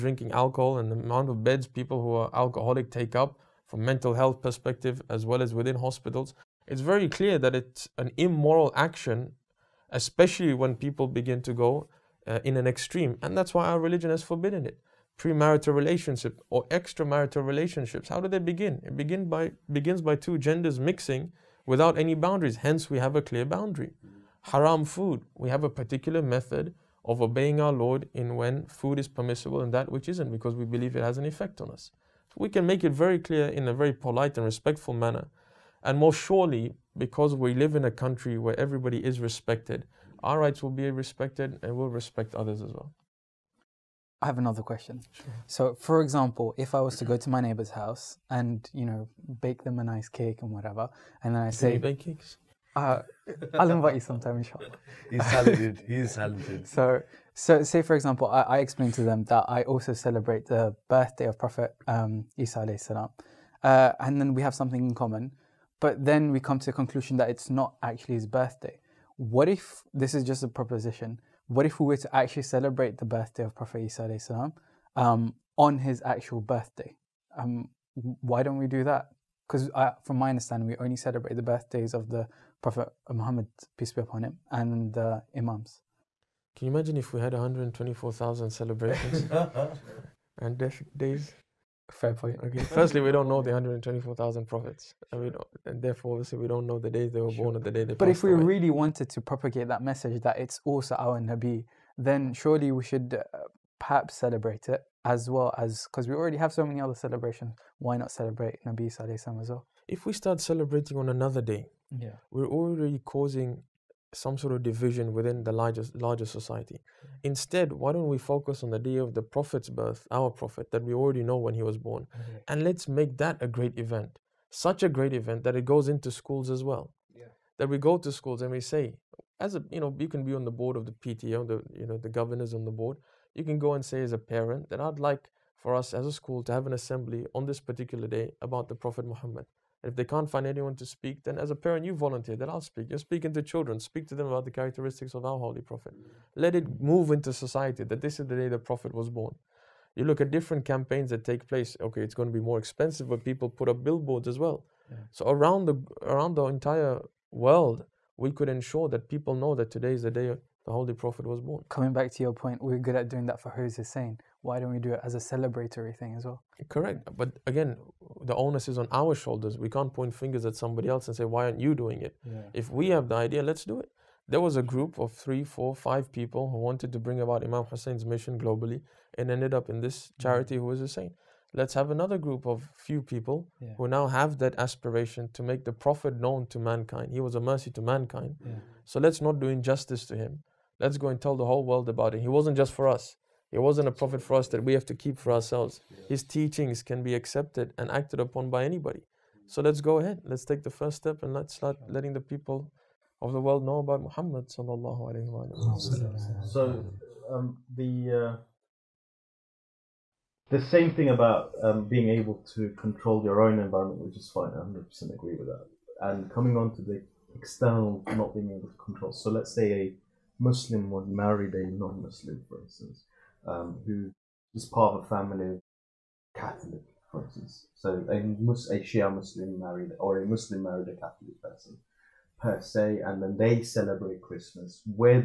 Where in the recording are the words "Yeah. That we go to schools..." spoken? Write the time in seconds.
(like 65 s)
127 s.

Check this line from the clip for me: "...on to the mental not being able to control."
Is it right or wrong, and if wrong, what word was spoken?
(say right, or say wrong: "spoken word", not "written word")
wrong: "external", not "mental".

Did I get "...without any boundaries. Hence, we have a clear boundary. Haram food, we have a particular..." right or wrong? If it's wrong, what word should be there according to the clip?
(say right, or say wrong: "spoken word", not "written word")
right.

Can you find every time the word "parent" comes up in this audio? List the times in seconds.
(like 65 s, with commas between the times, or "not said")
134 s, 141 s.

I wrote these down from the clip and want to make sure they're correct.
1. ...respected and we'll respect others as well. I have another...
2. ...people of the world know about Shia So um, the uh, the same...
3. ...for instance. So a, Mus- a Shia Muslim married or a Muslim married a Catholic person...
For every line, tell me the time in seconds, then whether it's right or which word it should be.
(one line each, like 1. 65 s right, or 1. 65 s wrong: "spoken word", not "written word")
1. 40 s right
2. 202 s wrong: "Muhammad", not "Shia"
3. 227 s right.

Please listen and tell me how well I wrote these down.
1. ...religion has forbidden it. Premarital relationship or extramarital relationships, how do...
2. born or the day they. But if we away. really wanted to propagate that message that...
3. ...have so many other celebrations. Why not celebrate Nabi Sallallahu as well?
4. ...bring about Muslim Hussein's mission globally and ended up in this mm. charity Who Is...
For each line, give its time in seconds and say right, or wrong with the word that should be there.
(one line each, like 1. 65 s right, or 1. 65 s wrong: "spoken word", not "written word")
1. 13 s right
2. 97 s right
3. 106 s right
4. 176 s wrong: "Imam", not "Muslim".